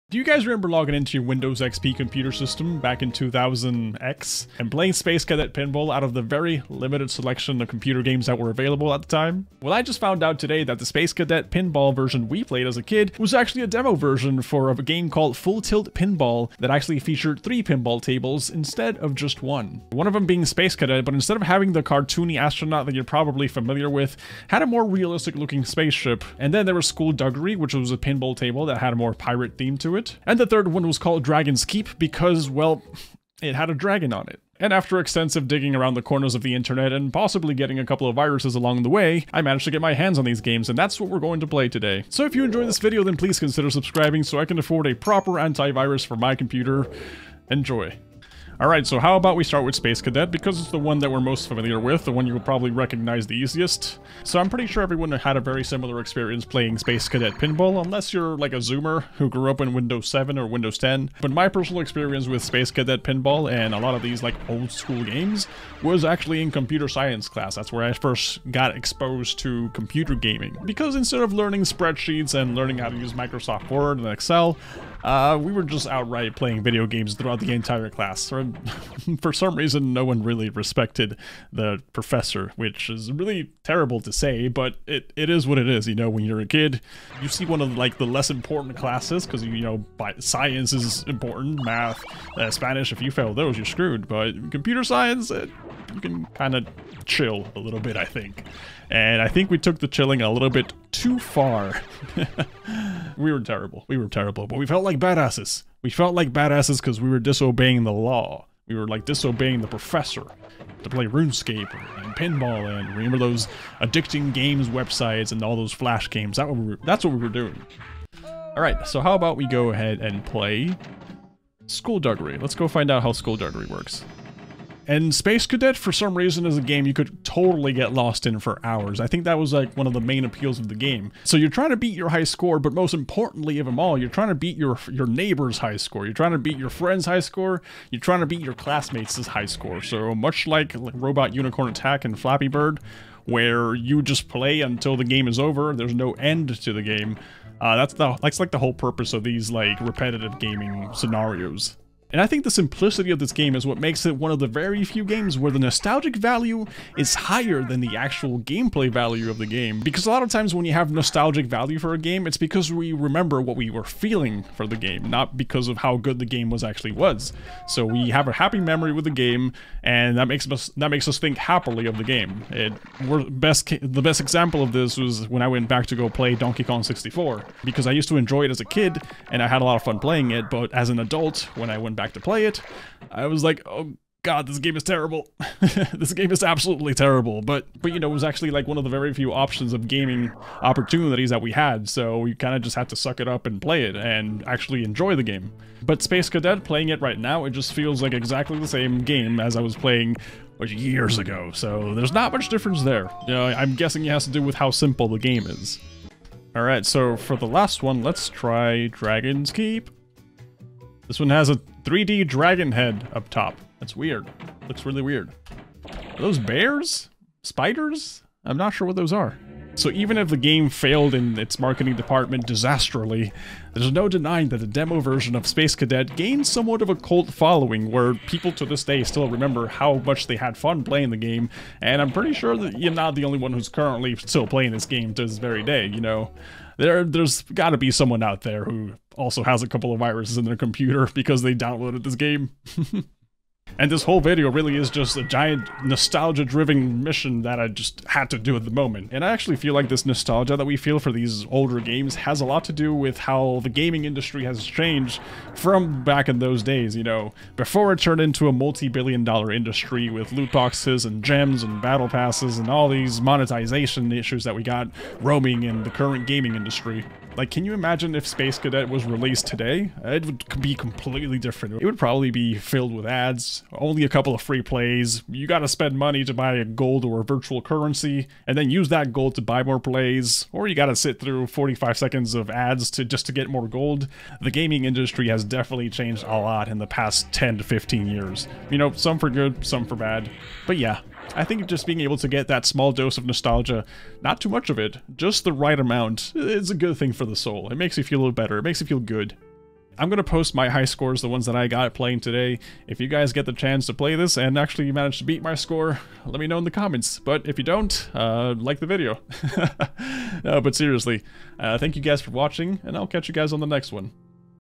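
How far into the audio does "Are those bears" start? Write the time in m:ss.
3:35.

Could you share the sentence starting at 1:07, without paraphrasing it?
That's where I first got exposed to computer gaming.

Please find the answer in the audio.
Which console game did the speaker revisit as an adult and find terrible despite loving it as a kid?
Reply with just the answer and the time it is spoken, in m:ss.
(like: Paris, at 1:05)
Donkey Kong 64, at 2:56.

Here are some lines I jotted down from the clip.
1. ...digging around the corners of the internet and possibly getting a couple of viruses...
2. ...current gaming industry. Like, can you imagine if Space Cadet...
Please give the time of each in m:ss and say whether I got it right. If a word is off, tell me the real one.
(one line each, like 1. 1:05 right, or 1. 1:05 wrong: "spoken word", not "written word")
1. 0:35 right
2. 4:25 right.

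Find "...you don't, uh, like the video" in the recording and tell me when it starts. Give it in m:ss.
5:07.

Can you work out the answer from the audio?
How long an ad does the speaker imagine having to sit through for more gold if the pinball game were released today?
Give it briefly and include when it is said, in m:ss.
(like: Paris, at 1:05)
45 seconds, at 4:41.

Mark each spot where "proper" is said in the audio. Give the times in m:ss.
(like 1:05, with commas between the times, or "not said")
0:44.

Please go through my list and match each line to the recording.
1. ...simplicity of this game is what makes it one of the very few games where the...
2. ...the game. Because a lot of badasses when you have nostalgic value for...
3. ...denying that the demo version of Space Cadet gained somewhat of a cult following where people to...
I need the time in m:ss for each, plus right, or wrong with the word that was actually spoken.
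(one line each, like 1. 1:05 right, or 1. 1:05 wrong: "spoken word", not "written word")
1. 2:32 right
2. 2:39 wrong: "times", not "badasses"
3. 3:44 right.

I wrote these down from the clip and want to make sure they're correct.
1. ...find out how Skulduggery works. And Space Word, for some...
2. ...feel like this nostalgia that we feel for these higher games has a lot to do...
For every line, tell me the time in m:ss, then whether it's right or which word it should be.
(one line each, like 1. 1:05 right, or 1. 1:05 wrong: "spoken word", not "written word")
1. 2:02 wrong: "Cadet", not "Word"
2. 4:09 wrong: "older", not "higher".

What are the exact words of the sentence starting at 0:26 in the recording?
And then there was Skulduggery, which was a pinball table that had a more pirate theme to it.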